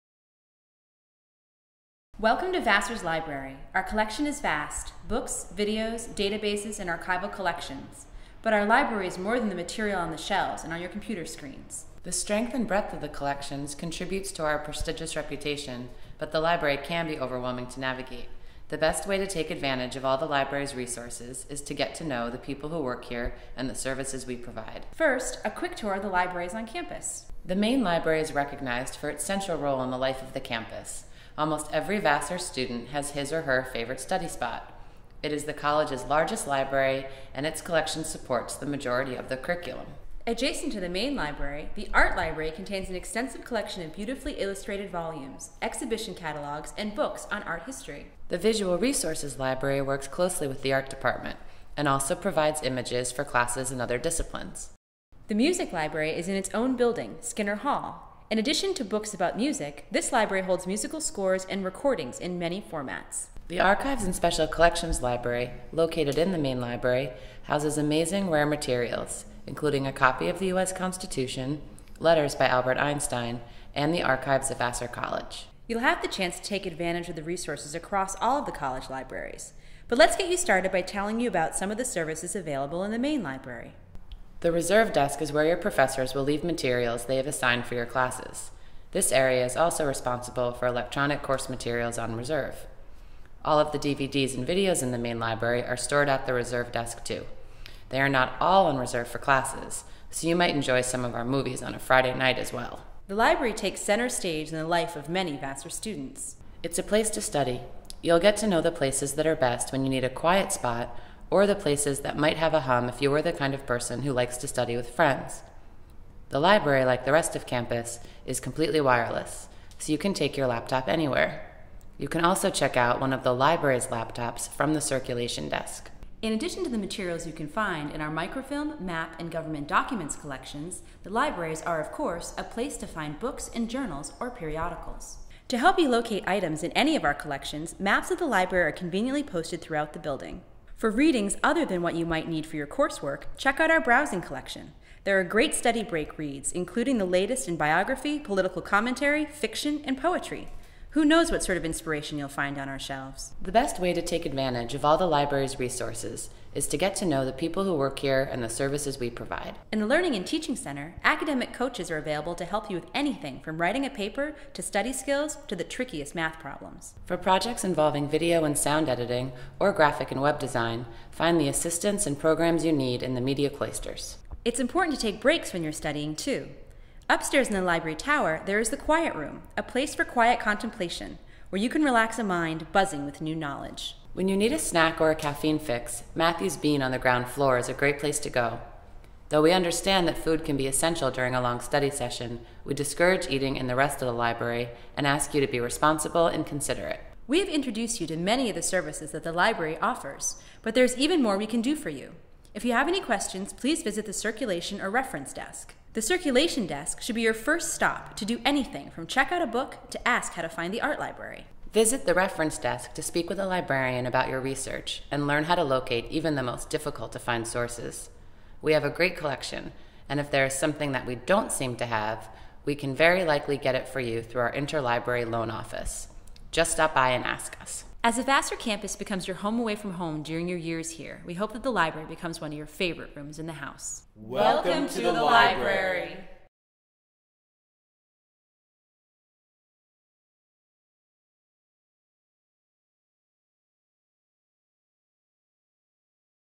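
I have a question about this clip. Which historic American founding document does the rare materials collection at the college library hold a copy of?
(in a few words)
U.S. Constitution.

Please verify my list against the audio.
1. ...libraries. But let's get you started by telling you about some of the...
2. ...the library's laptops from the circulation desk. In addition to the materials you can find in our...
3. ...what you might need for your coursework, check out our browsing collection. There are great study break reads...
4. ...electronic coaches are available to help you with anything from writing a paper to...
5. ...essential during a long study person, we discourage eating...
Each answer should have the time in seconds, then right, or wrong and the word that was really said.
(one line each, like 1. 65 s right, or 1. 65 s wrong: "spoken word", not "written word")
1. 78 s right
2. 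123 s right
3. 141 s right
4. 161 s wrong: "academic", not "electronic"
5. 190 s wrong: "session", not "person".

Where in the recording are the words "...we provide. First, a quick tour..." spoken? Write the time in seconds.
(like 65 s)
24 s.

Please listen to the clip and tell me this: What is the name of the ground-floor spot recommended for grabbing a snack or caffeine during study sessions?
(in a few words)
Matthew's Bean.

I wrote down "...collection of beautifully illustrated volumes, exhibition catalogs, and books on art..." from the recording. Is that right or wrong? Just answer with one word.
right.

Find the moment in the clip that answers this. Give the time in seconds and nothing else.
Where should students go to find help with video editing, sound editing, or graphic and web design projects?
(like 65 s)
173 s.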